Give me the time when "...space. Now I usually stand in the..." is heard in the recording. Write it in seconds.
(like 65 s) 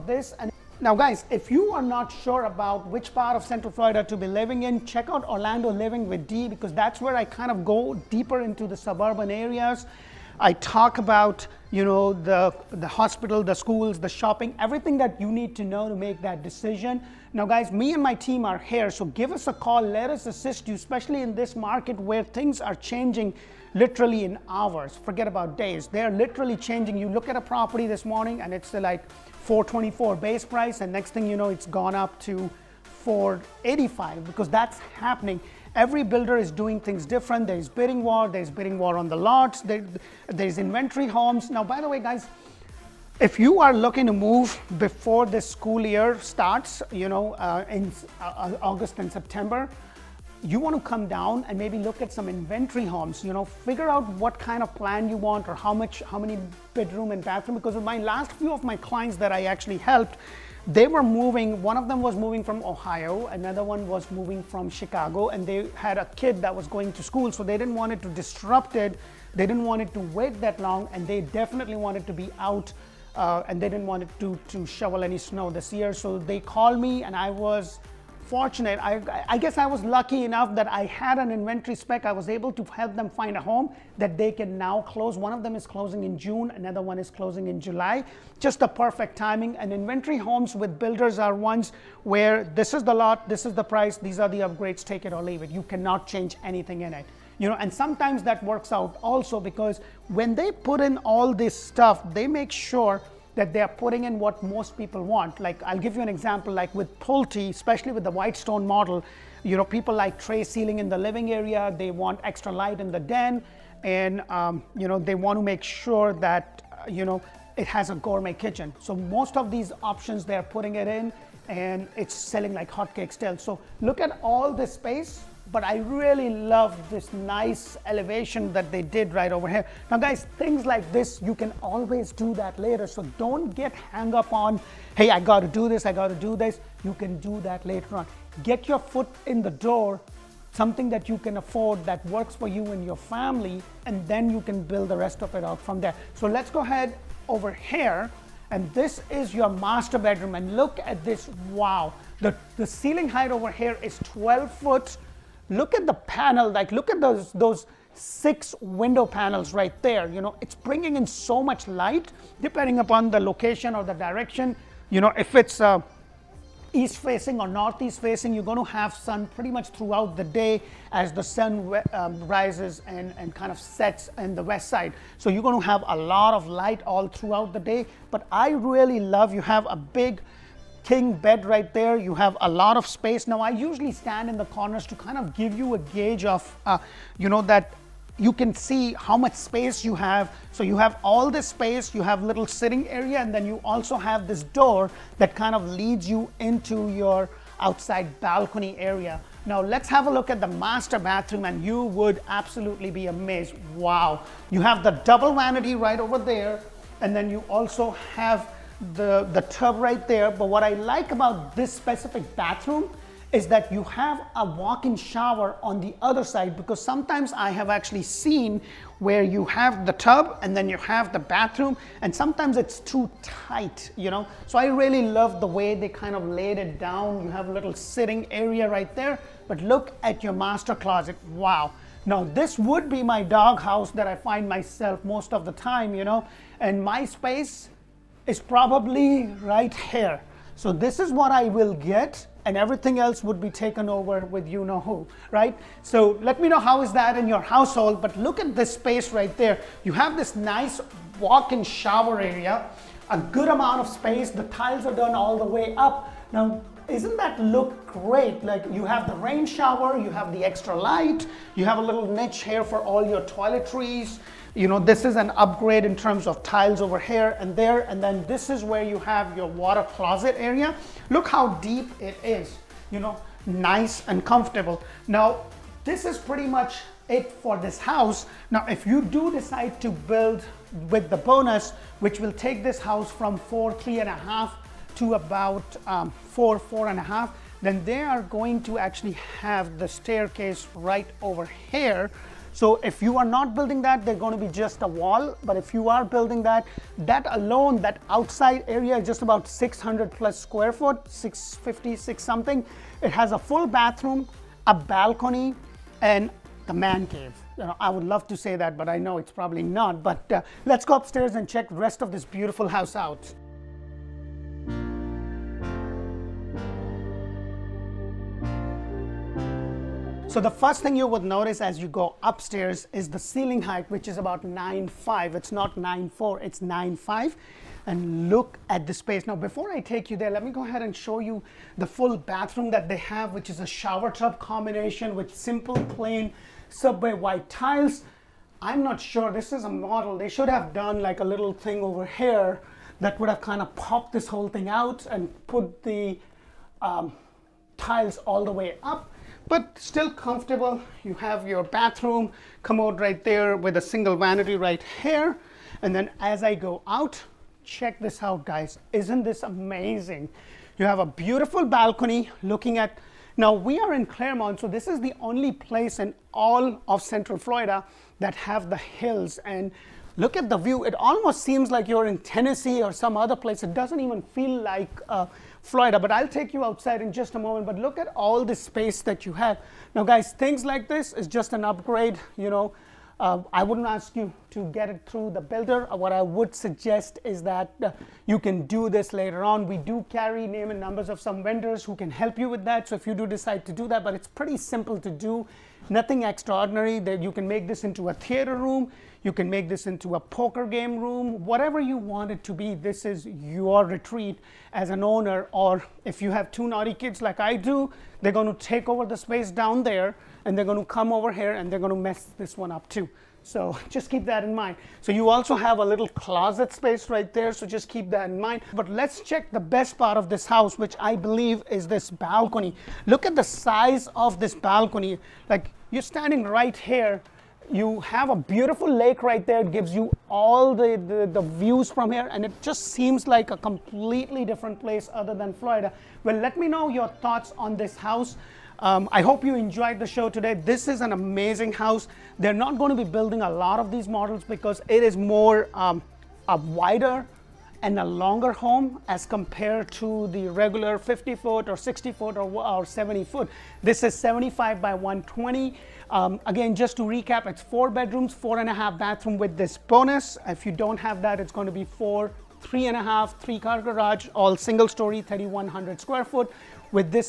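182 s.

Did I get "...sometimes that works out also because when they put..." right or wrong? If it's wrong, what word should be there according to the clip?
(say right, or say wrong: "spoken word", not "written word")
right.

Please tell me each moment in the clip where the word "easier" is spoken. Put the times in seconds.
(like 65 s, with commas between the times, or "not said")
not said.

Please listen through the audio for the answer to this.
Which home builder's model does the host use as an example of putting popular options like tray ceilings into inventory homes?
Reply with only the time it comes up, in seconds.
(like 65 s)
106 s.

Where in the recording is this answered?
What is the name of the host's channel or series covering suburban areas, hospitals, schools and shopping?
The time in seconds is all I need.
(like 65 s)
5 s.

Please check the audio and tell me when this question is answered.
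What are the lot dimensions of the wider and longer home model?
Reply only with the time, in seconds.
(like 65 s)
454 s.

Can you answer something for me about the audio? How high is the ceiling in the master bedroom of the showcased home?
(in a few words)
12 feet.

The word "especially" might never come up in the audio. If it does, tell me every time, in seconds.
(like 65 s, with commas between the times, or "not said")
20 s, 107 s.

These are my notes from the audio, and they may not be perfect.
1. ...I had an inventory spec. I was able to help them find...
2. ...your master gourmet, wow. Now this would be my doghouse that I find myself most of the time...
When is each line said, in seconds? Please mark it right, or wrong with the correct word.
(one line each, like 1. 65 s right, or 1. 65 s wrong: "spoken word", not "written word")
1. 80 s right
2. 230 s wrong: "closet", not "gourmet".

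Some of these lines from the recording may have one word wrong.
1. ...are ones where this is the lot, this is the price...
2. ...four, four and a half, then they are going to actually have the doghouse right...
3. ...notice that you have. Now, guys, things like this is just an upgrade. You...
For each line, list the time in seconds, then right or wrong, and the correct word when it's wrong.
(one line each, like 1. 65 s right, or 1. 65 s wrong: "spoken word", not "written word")
1. 91 s right
2. 286 s wrong: "staircase", not "doghouse"
3. 378 s wrong: "space", not "notice".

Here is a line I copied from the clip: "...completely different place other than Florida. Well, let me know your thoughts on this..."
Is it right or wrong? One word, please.
right.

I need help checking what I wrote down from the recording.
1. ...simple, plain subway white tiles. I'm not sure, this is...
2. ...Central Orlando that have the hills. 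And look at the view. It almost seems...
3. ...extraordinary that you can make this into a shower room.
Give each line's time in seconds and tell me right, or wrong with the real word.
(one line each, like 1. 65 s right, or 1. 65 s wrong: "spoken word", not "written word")
1. 335 s right
2. 367 s wrong: "Florida", not "Orlando"
3. 396 s wrong: "theater", not "shower".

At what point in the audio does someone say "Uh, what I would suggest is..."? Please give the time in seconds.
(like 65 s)
385 s.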